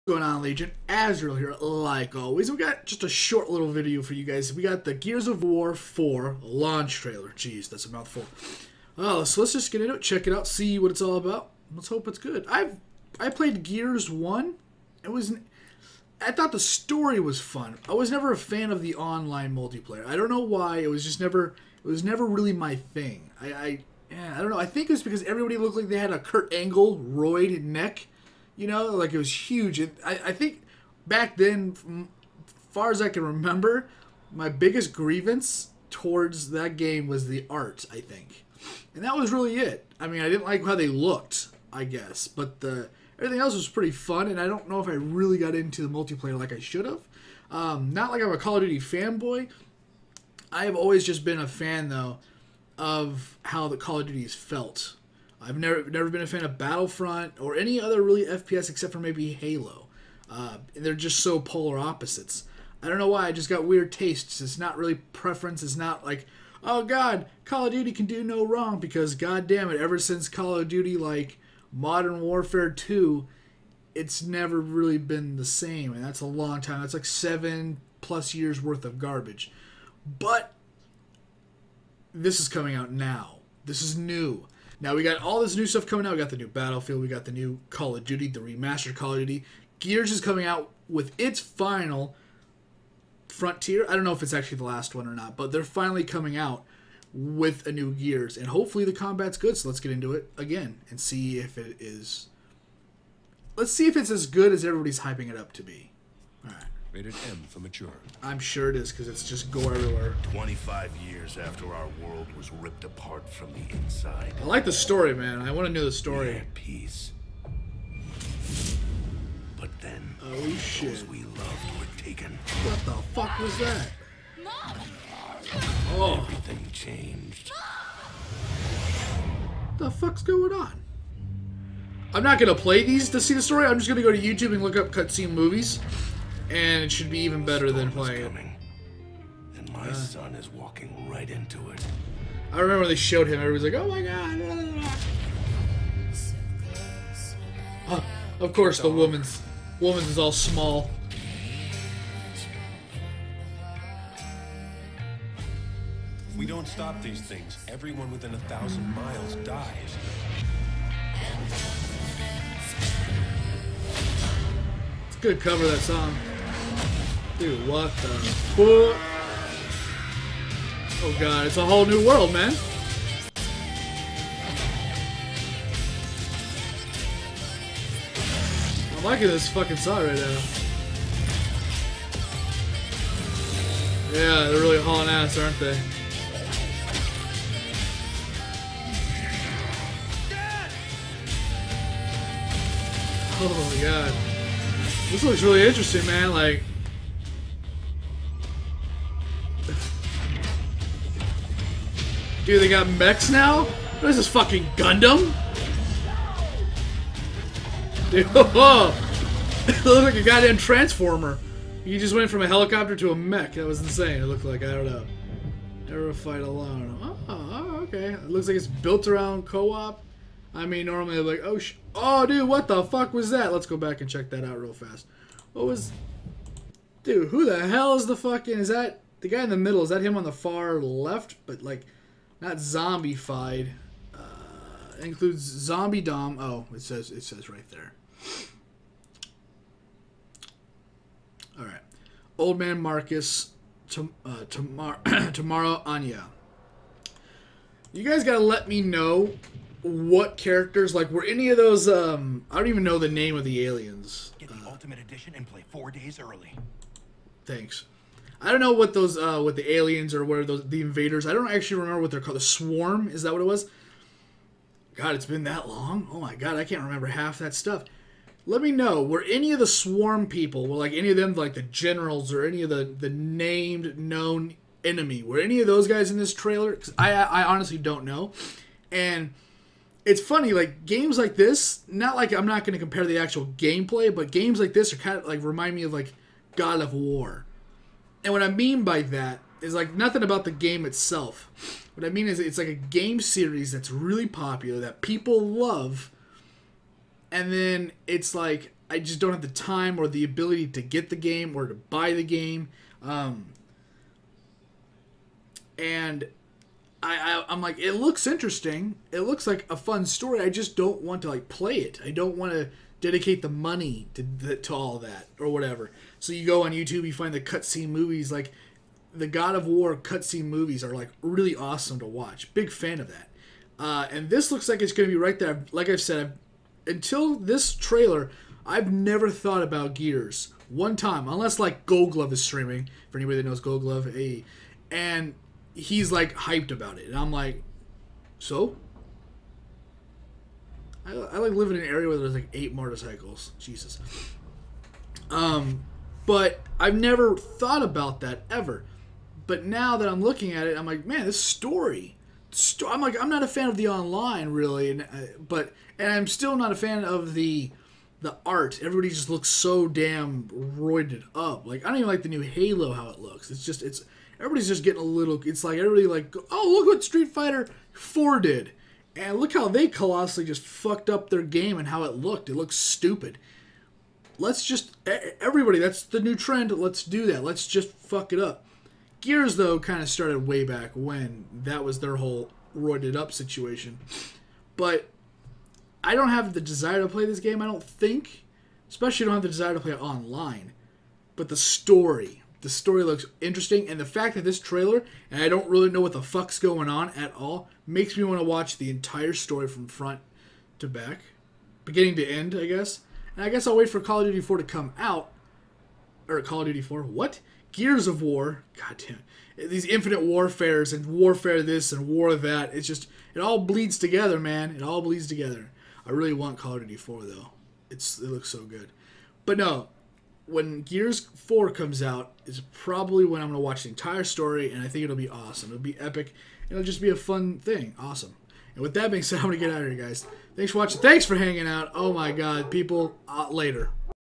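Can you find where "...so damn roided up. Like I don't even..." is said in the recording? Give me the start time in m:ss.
5:59.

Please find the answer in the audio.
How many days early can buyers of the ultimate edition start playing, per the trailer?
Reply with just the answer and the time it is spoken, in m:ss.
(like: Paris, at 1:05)
4, at 4:15.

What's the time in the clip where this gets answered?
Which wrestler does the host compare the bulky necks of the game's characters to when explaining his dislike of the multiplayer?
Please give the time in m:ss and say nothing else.
0:26.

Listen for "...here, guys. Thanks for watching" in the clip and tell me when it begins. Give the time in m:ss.
7:09.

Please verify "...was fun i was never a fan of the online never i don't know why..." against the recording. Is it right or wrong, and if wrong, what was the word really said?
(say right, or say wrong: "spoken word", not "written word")
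wrong: "multiplayer", not "never".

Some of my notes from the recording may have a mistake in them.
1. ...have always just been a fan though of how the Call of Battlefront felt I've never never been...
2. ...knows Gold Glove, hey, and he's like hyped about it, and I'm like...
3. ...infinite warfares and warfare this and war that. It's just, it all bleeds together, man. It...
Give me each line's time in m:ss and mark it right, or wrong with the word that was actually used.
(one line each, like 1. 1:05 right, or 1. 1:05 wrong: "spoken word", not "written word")
1. 0:50 wrong: "Duties", not "Battlefront"
2. 5:33 right
3. 6:49 right.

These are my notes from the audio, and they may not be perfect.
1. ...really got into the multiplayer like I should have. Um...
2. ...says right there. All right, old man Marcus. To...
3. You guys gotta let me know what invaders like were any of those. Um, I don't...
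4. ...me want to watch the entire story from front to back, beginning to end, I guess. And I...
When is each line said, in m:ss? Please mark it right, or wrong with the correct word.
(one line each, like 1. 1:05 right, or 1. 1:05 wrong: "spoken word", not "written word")
1. 0:44 right
2. 3:57 right
3. 4:07 wrong: "characters", not "invaders"
4. 6:38 right.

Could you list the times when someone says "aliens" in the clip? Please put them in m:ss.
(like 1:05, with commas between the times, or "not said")
4:13, 4:19.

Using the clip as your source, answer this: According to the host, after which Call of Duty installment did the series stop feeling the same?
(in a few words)
Modern Warfare 2.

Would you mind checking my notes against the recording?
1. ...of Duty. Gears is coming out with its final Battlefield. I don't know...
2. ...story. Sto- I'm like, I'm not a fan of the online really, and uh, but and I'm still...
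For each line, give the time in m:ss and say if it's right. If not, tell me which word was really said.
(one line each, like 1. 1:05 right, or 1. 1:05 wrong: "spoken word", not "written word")
1. 1:29 wrong: "Frontier", not "Battlefield"
2. 5:51 right.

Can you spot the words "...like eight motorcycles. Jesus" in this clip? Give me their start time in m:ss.
5:42.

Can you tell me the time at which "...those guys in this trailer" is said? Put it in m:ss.
4:35.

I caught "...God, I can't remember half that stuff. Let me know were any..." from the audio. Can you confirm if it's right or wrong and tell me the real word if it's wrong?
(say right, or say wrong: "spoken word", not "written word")
right.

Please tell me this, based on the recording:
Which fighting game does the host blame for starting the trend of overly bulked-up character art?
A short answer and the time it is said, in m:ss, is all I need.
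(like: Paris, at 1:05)
Street Fighter Four, at 6:07.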